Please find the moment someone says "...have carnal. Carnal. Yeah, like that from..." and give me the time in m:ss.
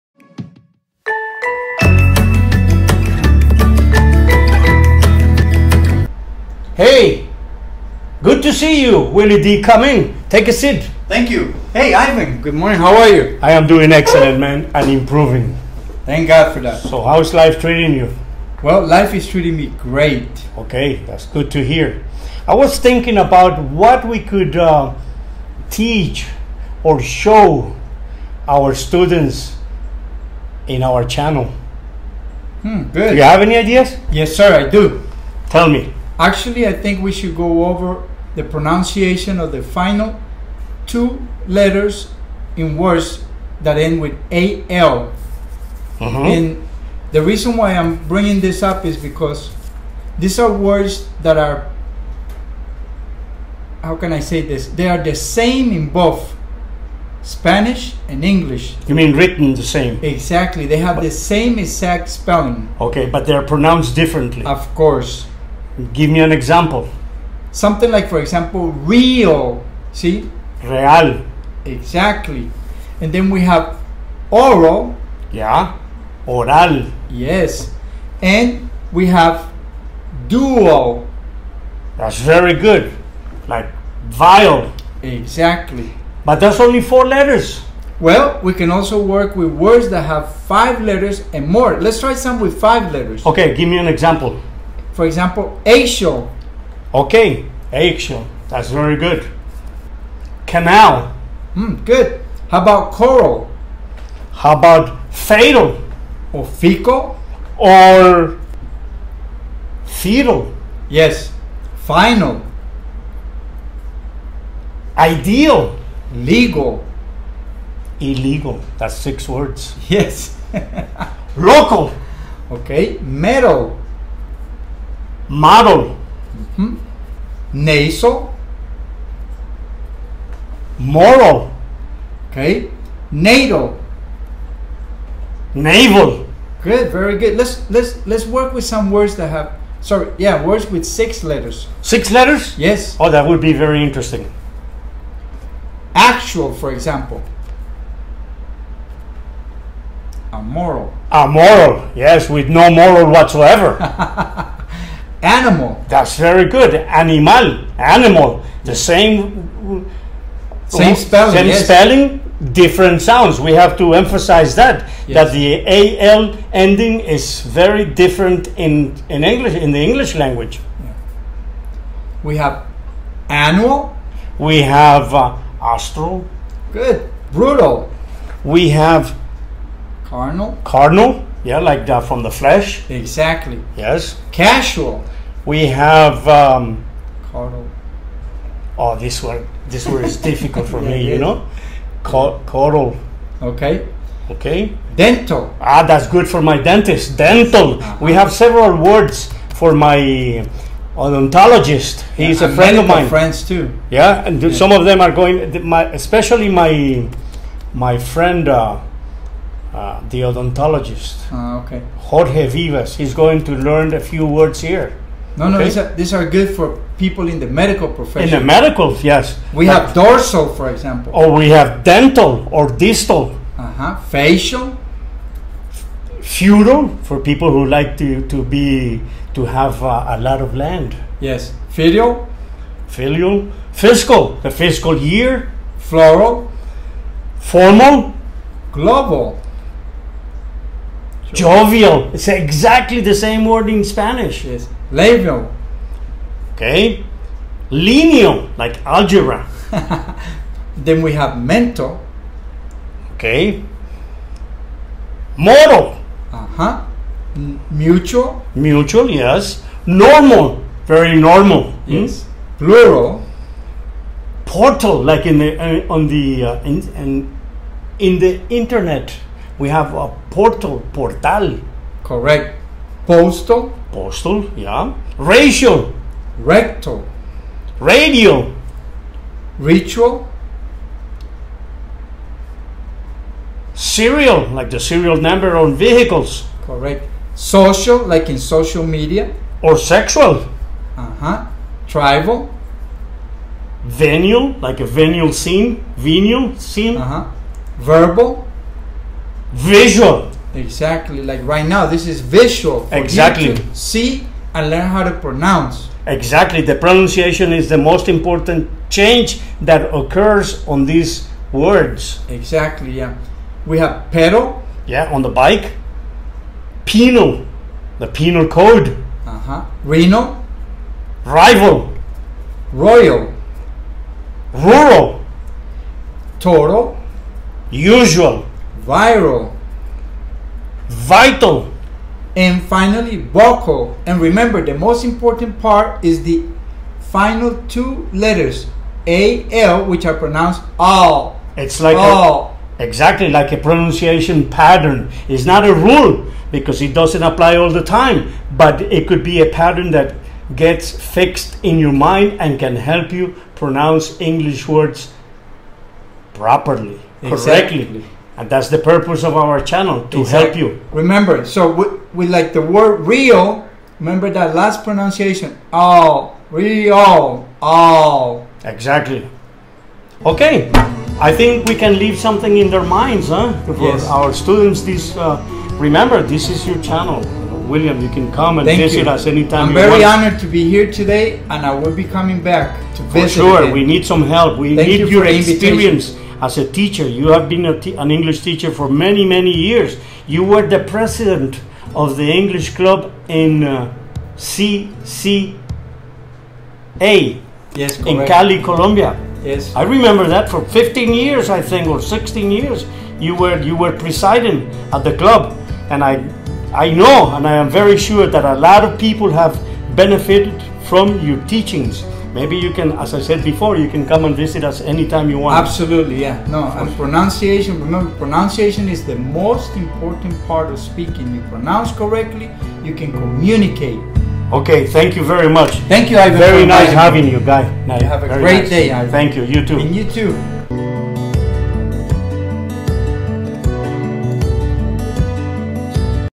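2:58.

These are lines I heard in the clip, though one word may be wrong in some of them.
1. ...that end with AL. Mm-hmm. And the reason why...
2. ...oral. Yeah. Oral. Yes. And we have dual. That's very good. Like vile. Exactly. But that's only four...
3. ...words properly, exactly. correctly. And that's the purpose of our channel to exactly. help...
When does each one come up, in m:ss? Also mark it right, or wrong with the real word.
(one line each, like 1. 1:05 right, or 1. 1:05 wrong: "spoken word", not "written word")
1. 0:43 right
2. 1:14 right
3. 5:54 right.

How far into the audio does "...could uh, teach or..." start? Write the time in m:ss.
0:24.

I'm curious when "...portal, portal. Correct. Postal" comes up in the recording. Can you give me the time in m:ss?
4:30.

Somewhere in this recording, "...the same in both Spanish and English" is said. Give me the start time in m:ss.
0:55.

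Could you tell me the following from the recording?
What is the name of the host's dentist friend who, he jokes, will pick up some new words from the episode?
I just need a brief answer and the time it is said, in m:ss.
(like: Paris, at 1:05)
Jorge Vivas, at 3:31.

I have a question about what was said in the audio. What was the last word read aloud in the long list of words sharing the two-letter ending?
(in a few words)
Vocal.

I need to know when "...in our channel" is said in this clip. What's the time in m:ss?
0:30.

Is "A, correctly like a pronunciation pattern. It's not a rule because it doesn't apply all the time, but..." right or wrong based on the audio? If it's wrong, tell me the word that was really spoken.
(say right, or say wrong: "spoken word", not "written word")
wrong: "exactly", not "correctly".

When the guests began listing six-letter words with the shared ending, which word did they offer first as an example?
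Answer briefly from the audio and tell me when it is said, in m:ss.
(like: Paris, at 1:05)
Actual, at 2:25.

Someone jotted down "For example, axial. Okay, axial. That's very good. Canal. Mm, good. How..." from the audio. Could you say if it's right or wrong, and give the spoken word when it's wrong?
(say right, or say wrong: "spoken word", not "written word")
right.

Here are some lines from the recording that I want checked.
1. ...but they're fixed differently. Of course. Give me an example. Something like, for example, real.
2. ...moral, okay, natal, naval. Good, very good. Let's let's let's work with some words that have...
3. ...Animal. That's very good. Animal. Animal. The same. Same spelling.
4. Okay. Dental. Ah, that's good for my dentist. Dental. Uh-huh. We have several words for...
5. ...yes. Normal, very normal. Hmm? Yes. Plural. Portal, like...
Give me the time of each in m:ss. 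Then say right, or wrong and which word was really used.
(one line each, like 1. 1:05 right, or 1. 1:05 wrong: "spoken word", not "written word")
1. 1:03 wrong: "pronounced", not "fixed"
2. 2:10 right
3. 2:35 right
4. 3:14 right
5. 4:19 right.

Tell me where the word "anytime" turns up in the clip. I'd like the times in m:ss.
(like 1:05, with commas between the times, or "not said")
6:19, 6:54.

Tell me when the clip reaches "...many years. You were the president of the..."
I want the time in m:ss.
6:29.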